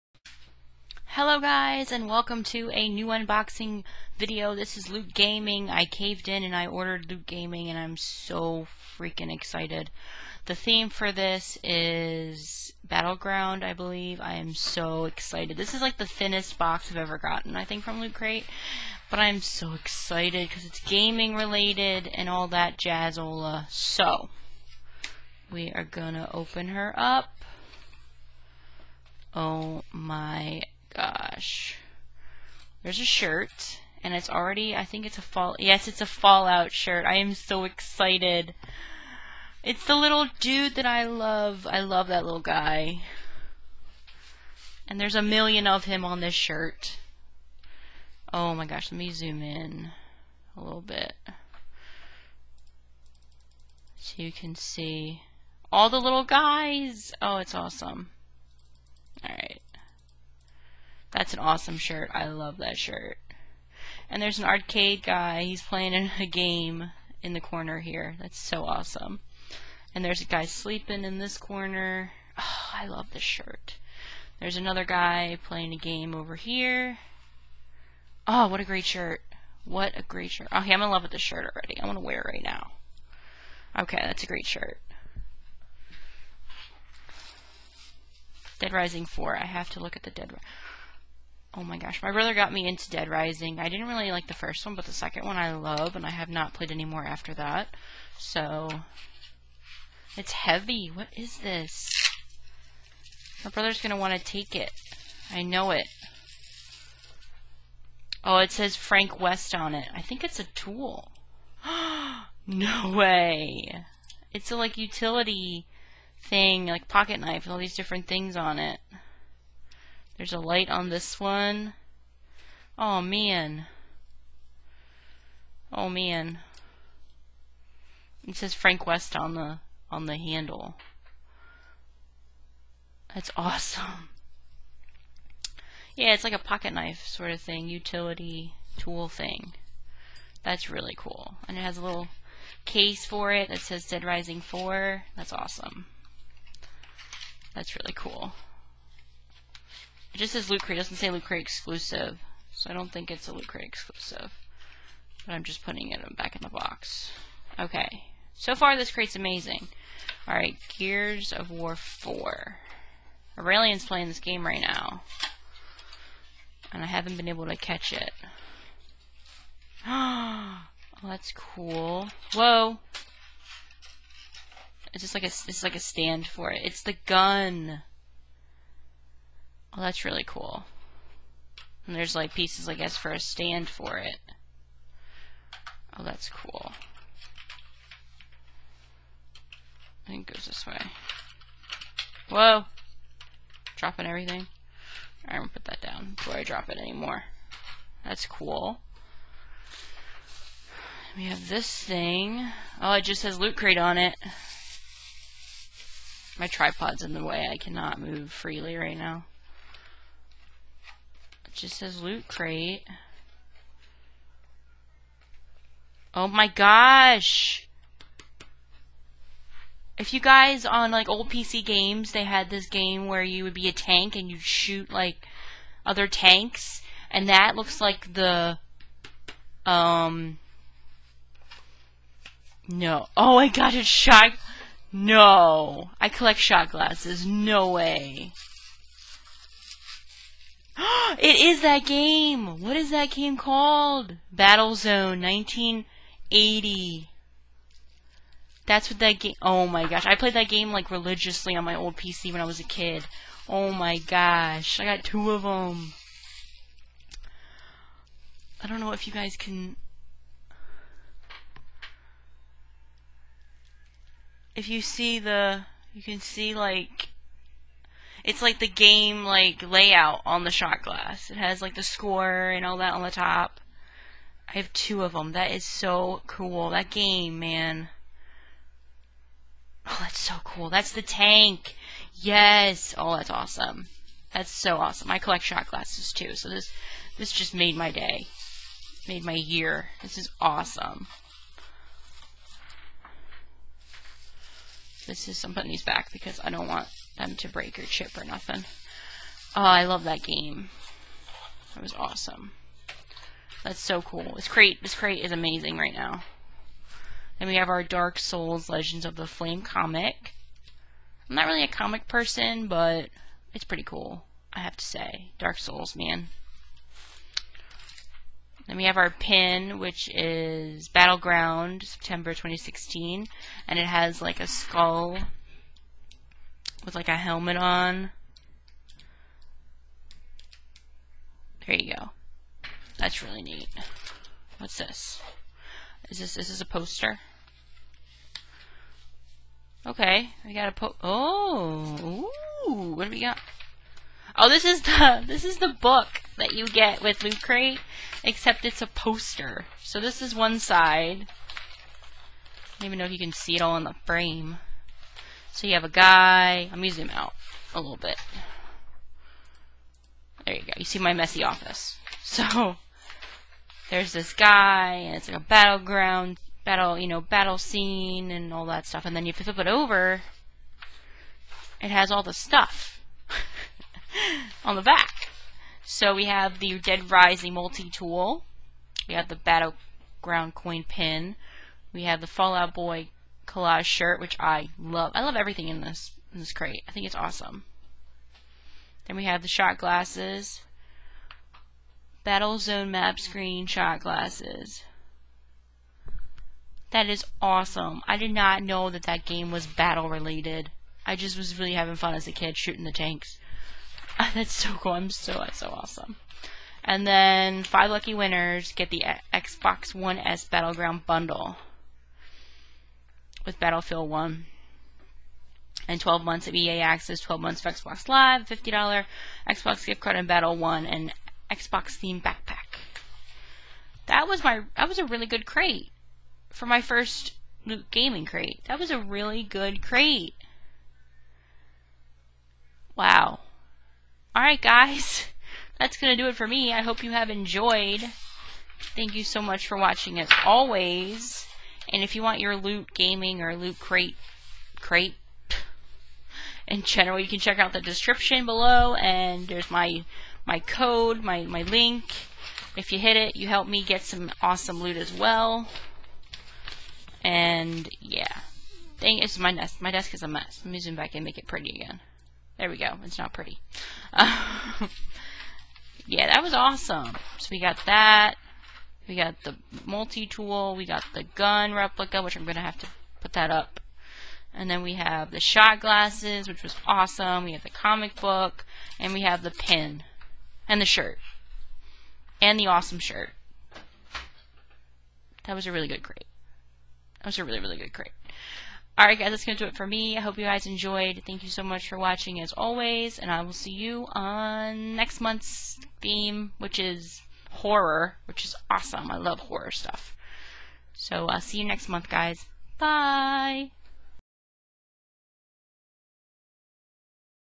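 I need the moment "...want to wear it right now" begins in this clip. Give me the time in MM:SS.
01:21.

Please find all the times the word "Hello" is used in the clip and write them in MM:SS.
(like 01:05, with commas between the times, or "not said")
00:01.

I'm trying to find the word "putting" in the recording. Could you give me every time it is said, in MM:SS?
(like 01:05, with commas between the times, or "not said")
02:35, 04:55.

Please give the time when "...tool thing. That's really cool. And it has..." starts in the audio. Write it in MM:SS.
02:18.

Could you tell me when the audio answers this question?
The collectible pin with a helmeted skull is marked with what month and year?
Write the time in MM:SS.
05:21.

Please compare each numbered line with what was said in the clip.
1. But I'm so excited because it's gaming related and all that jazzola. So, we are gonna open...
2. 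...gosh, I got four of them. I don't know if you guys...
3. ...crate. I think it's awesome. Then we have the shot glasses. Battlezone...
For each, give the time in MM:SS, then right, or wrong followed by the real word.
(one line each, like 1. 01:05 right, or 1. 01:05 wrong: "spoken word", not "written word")
1. 00:19 right
2. 04:13 wrong: "two", not "four"
3. 06:26 right.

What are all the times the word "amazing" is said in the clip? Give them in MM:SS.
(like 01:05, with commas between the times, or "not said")
02:39, 05:05.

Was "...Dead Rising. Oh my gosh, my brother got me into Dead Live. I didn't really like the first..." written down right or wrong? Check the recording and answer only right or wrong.
wrong.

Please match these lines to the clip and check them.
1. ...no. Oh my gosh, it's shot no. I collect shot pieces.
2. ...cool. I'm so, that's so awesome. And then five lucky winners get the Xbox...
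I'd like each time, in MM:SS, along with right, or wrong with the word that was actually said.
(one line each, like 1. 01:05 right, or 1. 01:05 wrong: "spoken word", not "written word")
1. 03:52 wrong: "glasses", not "pieces"
2. 06:44 right.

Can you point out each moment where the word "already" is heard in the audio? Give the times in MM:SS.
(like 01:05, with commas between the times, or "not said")
00:34, 01:21.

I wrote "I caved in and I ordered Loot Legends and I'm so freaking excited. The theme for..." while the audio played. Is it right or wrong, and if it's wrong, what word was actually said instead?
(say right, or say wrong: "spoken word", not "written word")
wrong: "Gaming", not "Legends".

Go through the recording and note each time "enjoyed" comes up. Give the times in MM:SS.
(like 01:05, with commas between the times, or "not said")
07:17, 08:10.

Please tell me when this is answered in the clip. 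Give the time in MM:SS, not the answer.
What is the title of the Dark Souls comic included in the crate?
05:08.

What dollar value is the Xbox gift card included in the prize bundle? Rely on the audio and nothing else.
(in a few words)
$50.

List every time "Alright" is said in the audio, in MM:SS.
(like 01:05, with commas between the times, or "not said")
00:59, 02:40, 03:15, 07:14, 08:08.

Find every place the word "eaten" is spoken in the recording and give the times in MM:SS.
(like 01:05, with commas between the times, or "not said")
not said.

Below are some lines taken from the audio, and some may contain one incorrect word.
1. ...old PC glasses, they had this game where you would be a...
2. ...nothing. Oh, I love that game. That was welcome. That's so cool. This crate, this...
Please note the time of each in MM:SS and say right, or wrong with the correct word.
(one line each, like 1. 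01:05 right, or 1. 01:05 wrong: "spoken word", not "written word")
1. 03:41 wrong: "games", not "glasses"
2. 04:58 wrong: "awesome", not "welcome".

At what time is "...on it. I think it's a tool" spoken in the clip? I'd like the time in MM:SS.
01:49.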